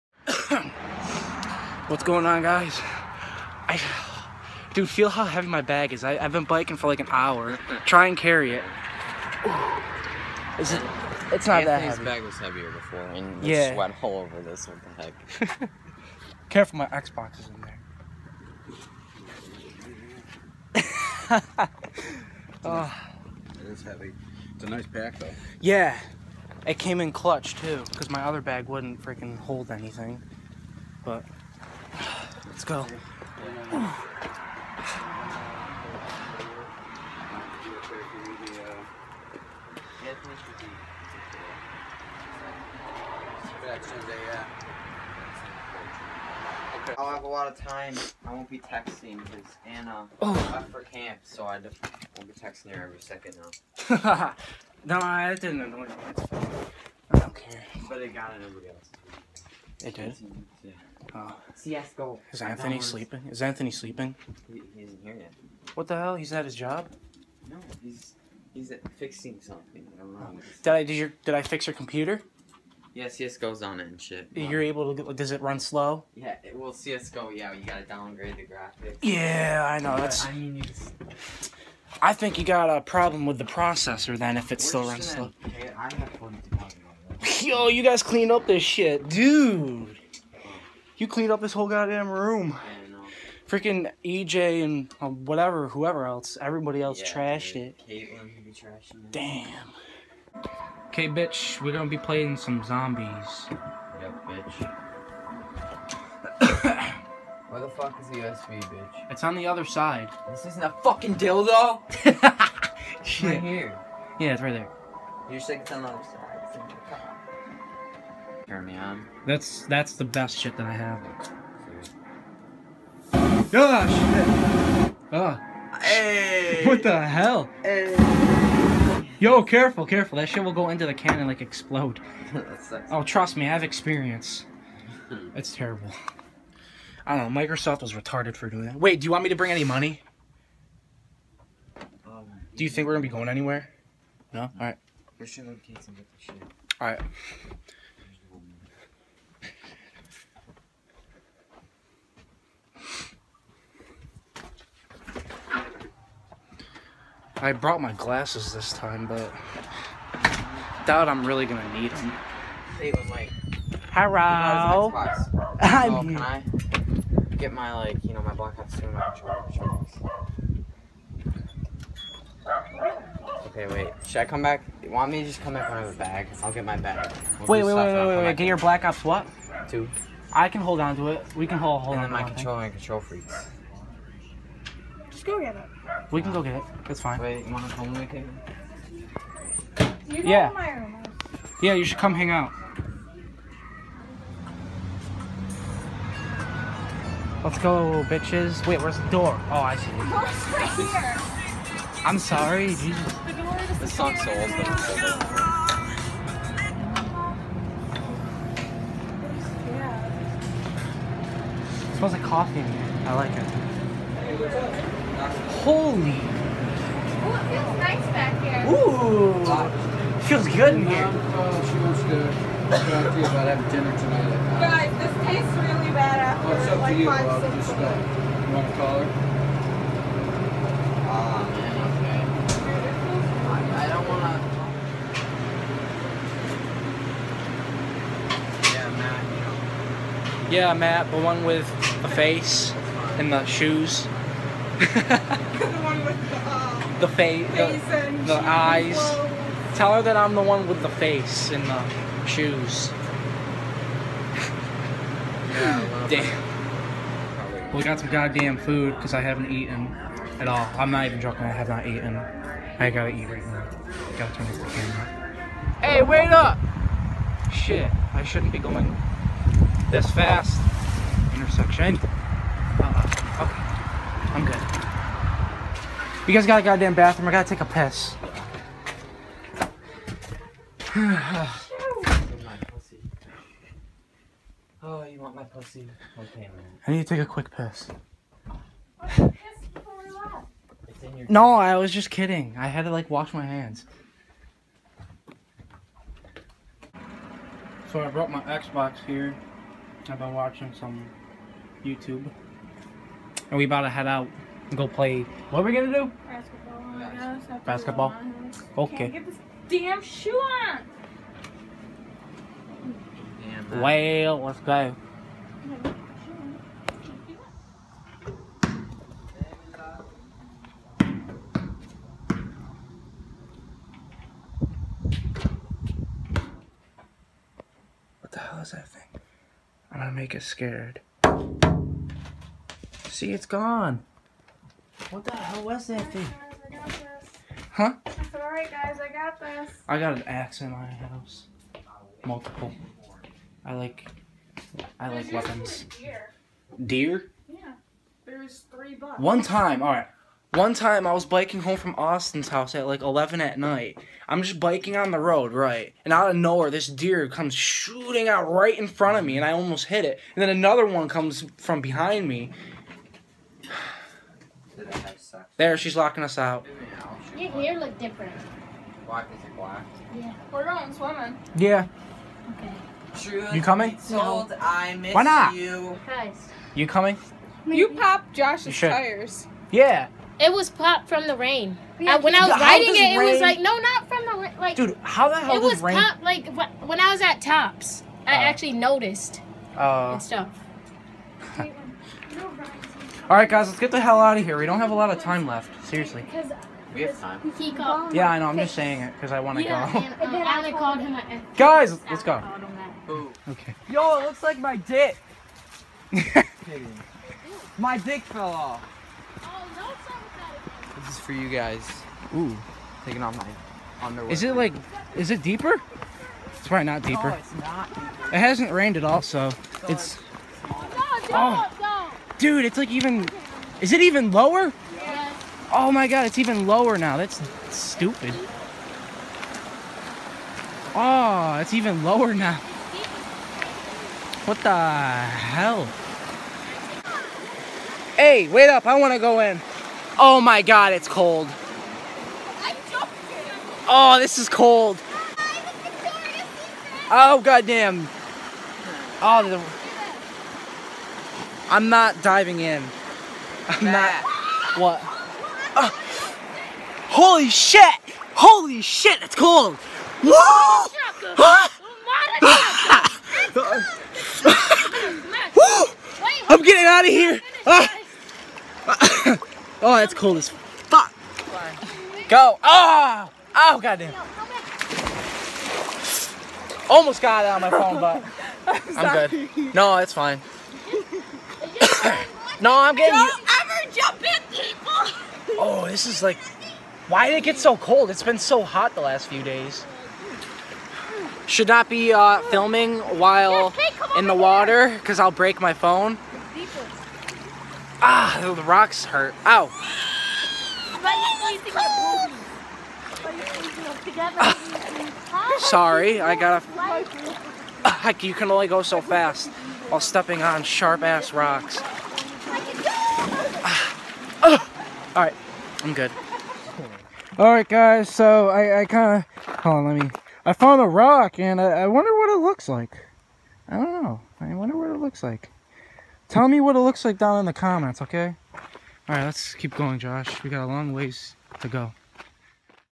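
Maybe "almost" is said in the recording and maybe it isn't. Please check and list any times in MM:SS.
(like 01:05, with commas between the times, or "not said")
05:59, 07:56.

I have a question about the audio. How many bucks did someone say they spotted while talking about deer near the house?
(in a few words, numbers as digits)
3.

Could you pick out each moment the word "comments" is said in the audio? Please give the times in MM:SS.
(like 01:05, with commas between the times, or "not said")
08:47.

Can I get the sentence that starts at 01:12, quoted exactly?
Yeah, CS:GO's on it and shit.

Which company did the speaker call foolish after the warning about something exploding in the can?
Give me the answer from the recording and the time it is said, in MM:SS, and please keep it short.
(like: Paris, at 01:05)
Microsoft, at 02:17.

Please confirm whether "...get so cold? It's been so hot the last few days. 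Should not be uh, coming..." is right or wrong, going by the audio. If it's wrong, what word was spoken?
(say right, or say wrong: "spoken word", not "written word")
wrong: "filming", not "coming".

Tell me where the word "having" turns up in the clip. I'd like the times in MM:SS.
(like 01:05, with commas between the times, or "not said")
03:43.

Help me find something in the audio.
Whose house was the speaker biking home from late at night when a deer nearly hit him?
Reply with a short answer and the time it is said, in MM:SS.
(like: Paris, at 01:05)
Austin's house, at 05:51.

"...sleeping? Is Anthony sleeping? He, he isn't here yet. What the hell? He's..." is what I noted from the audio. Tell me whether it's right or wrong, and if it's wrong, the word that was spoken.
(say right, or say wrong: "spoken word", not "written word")
right.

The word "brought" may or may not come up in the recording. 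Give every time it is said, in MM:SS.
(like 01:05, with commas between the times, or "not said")
02:37, 04:58.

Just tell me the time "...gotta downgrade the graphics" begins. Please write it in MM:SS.
01:17.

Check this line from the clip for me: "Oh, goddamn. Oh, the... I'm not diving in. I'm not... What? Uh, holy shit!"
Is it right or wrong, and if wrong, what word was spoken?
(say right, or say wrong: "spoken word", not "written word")
right.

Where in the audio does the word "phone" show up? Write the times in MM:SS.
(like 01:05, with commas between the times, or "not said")
07:57, 08:15.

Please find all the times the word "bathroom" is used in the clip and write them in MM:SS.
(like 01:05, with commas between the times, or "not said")
04:36.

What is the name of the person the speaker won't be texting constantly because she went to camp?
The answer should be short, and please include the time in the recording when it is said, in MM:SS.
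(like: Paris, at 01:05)
Anna, at 00:49.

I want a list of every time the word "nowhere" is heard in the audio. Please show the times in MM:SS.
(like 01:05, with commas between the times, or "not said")
05:56.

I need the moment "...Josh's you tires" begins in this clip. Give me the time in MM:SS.
06:18.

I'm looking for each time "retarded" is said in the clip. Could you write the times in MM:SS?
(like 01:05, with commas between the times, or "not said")
02:17.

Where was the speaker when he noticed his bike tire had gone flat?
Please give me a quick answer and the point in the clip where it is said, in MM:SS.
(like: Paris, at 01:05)
Tops, at 06:27.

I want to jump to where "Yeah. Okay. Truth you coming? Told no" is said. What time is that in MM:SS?
06:11.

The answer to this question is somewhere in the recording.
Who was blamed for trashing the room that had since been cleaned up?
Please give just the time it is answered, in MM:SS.
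01:34.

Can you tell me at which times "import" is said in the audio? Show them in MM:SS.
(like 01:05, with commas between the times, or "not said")
not said.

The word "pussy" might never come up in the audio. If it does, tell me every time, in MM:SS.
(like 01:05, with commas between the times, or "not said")
04:45.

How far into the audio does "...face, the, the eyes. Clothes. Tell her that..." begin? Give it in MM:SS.
04:07.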